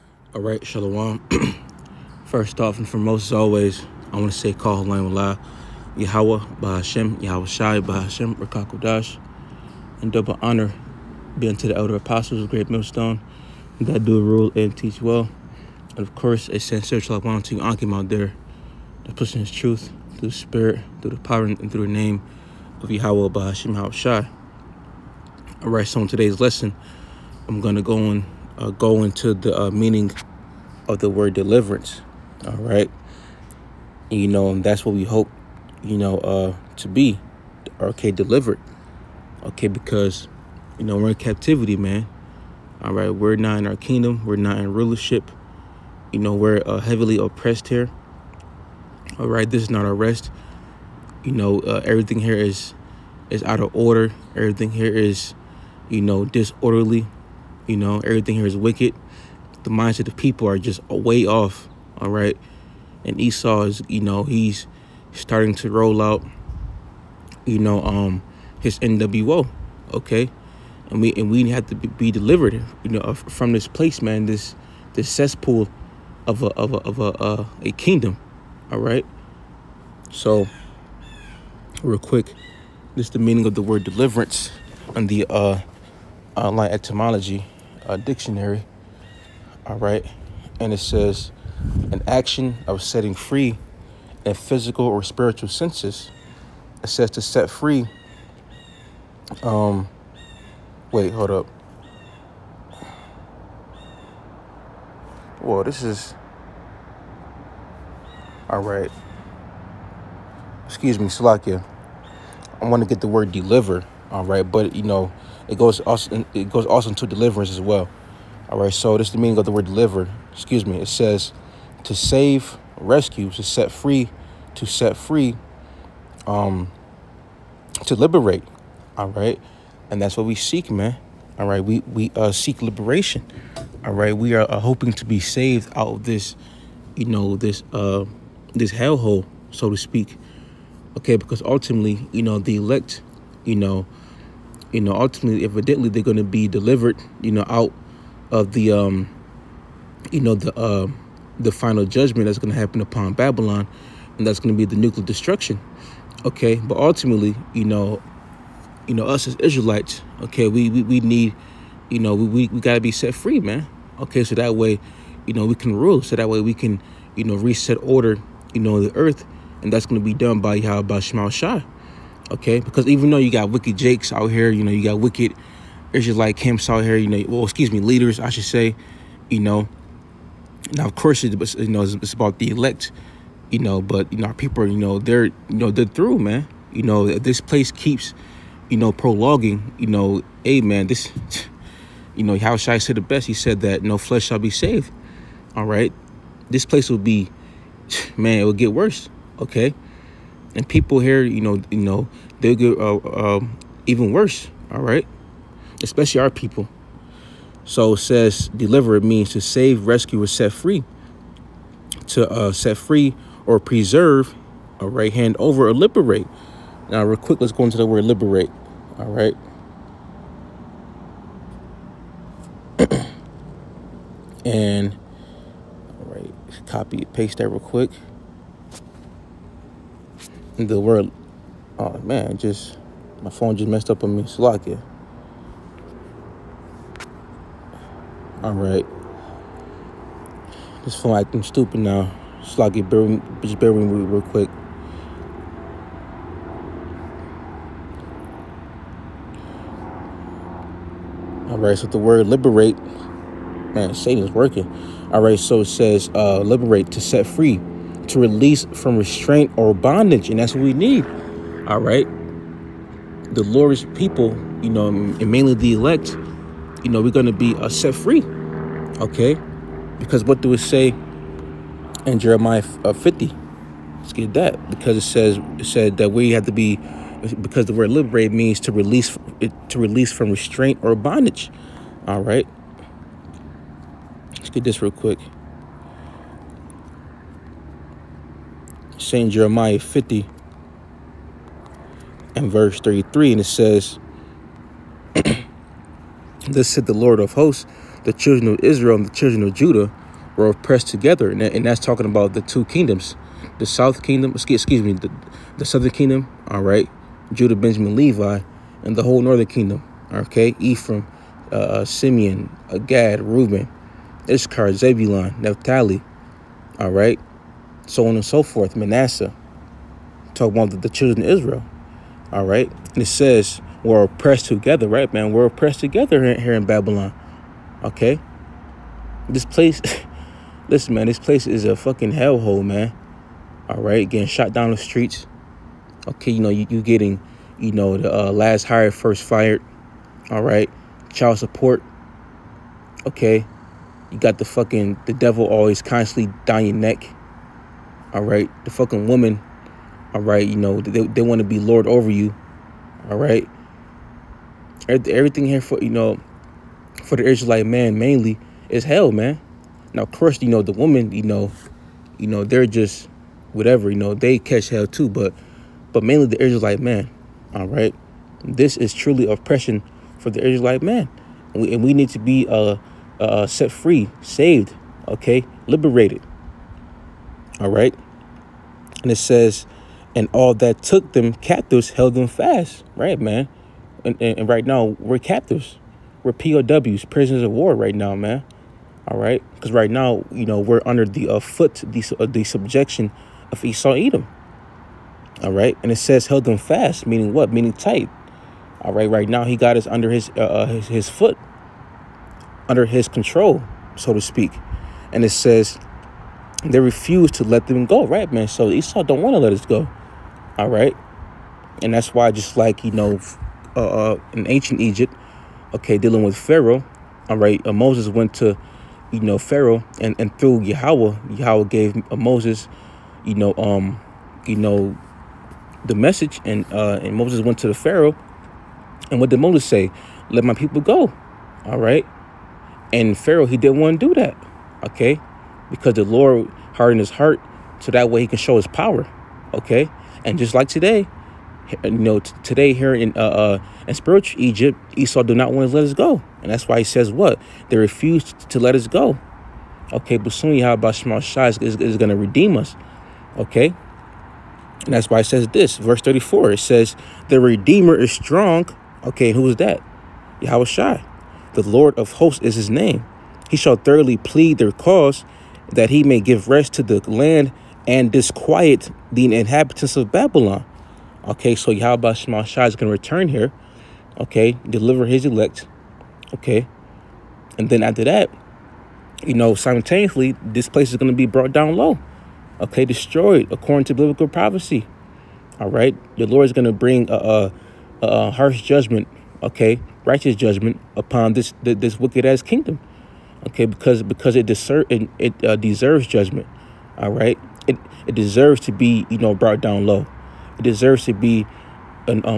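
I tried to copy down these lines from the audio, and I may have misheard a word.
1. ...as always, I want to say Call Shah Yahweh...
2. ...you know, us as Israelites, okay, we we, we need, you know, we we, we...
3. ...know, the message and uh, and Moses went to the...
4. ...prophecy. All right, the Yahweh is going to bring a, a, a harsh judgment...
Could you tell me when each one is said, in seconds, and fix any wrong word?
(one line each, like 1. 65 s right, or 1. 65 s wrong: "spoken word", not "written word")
1. 3 s wrong: "Halayim", not "Shah"
2. 158 s right
3. 424 s right
4. 484 s wrong: "Lord", not "Yahweh".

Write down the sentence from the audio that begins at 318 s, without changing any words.
Manasseh, talking about the, the children of Israel, all right?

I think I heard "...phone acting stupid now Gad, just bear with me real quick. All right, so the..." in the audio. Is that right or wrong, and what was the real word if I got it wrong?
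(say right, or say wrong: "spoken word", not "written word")
wrong: "Slocky", not "Gad".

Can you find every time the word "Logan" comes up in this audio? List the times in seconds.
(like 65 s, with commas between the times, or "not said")
not said.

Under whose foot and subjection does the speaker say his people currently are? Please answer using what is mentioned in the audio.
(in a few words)
Esau Edom.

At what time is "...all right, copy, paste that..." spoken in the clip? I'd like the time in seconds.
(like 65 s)
225 s.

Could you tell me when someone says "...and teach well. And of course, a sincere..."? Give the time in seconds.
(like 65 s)
14 s.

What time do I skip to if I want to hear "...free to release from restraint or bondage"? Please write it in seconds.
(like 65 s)
257 s.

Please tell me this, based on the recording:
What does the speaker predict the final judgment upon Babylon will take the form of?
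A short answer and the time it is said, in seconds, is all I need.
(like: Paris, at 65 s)
Nuclear destruction, at 154 s.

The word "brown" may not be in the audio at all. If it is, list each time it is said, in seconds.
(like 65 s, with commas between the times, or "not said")
not said.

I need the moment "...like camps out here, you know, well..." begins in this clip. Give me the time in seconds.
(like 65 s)
176 s.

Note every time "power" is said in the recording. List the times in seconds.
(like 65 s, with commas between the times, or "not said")
21 s, 438 s.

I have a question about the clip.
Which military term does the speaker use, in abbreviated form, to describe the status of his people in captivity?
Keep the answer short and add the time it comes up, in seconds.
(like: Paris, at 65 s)
POWs, at 386 s.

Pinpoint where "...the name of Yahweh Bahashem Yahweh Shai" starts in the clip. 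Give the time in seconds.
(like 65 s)
21 s.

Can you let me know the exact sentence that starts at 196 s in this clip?
This place will be, man, it will get worse, okay?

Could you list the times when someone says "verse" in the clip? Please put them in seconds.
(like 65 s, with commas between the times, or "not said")
292 s, 455 s.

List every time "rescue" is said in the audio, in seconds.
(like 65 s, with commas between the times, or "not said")
122 s, 209 s.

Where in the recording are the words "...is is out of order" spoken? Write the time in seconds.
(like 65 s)
52 s.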